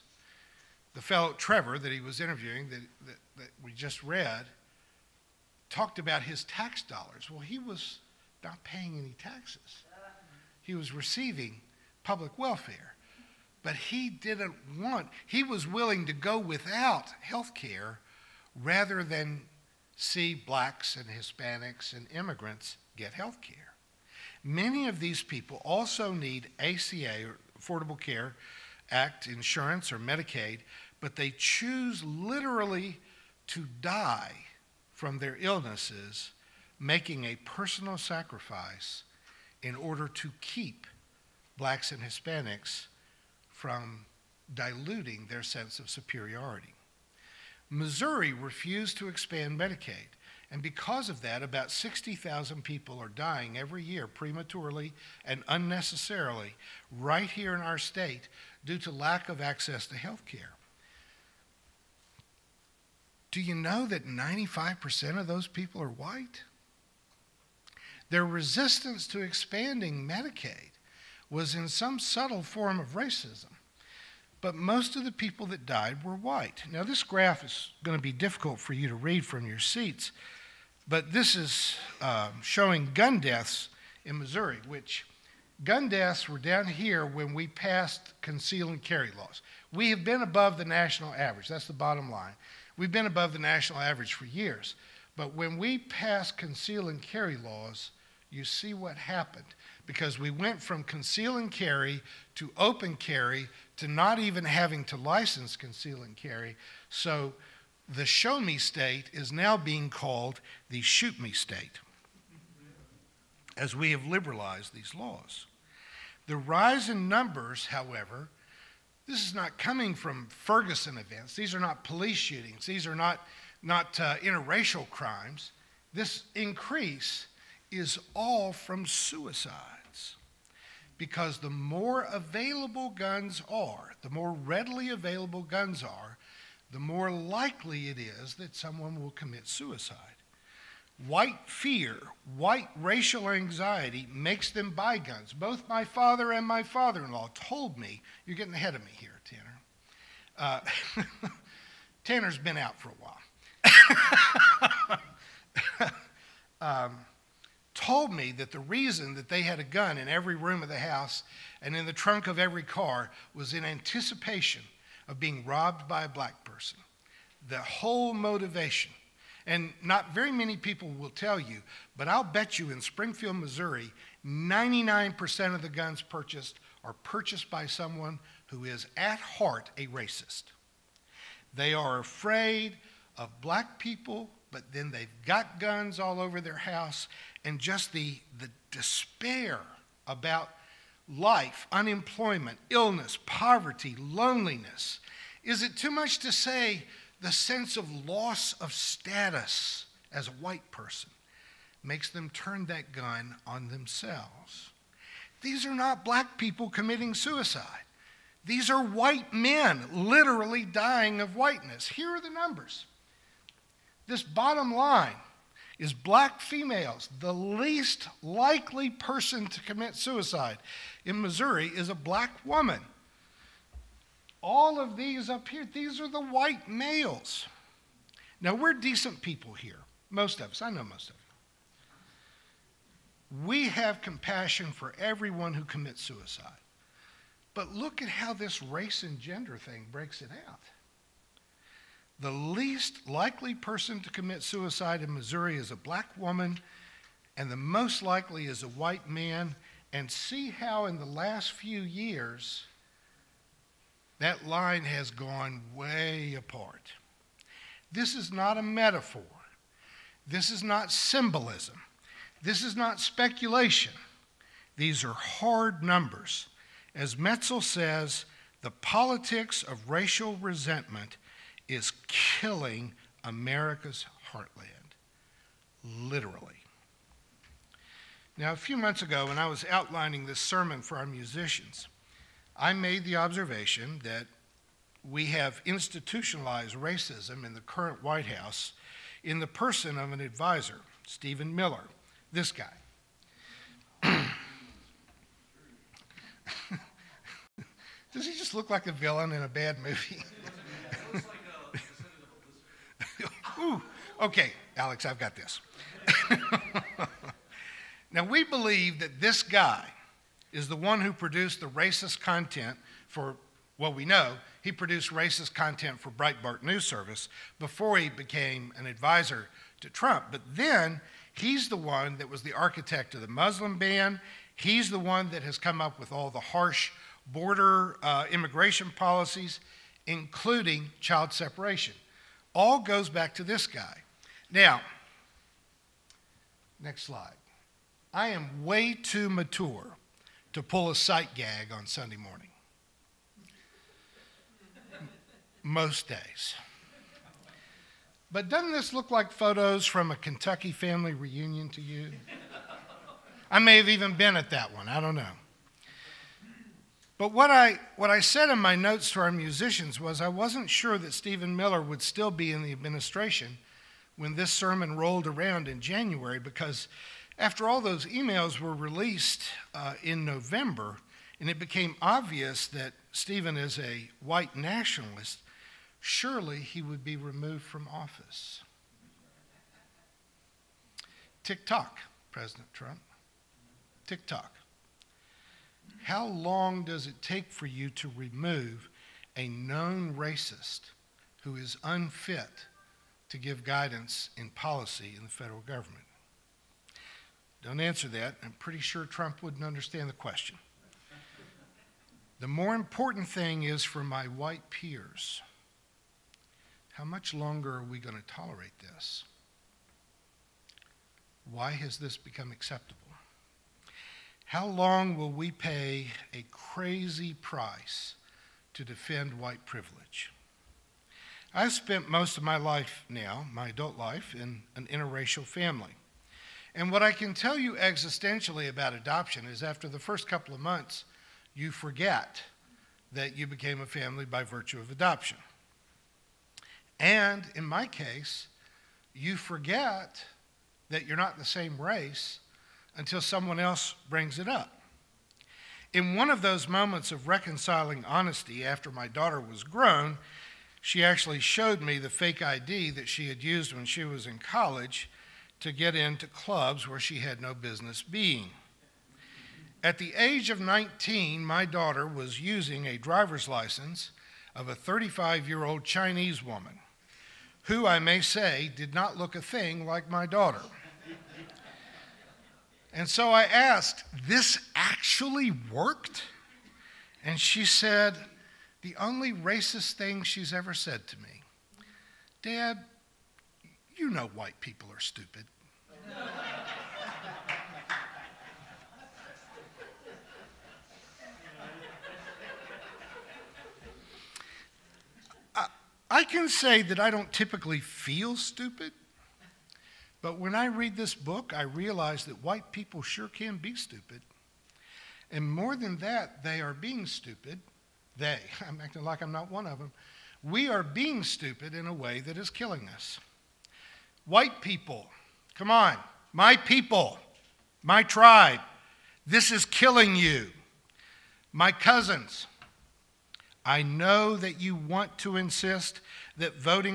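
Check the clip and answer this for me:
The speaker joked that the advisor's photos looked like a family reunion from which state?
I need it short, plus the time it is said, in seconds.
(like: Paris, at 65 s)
Kentucky, at 350 s.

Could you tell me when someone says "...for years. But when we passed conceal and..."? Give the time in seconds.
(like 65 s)
94 s.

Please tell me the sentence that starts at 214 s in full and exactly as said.
This bottom line is black females.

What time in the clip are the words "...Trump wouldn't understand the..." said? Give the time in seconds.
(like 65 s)
399 s.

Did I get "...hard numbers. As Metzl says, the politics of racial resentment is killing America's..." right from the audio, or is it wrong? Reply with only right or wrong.
right.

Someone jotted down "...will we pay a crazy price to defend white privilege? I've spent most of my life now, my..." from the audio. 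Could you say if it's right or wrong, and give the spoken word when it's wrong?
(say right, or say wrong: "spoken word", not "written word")
right.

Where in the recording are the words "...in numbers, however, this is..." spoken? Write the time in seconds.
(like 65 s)
116 s.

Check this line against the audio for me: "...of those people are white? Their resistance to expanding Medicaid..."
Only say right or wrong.
right.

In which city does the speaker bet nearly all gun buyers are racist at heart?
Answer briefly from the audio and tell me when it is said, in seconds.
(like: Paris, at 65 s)
Springfield, at 172 s.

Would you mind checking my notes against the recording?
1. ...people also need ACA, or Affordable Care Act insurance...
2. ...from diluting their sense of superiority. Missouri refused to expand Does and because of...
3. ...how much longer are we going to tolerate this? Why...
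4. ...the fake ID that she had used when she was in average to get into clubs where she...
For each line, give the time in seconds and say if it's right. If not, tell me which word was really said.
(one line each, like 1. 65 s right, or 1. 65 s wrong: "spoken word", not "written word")
1. 25 s right
2. 43 s wrong: "Medicaid", not "Does"
3. 406 s right
4. 451 s wrong: "college", not "average".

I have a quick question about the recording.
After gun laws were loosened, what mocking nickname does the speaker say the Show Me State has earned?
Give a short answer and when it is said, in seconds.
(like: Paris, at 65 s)
shoot me state, at 110 s.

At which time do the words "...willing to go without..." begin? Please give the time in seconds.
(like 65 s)
15 s.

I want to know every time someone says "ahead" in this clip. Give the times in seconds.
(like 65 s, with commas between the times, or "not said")
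148 s.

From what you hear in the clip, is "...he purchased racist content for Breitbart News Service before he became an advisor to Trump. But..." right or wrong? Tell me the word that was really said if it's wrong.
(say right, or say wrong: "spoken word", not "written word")
wrong: "produced", not "purchased".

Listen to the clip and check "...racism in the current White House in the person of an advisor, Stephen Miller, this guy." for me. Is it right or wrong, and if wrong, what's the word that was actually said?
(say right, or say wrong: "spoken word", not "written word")
right.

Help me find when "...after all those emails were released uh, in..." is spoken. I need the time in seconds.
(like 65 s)
367 s.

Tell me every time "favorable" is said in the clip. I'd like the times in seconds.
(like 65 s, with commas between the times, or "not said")
not said.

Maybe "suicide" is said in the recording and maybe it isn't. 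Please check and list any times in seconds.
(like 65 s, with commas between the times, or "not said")
128 s, 139 s, 207 s, 219 s, 236 s, 244 s.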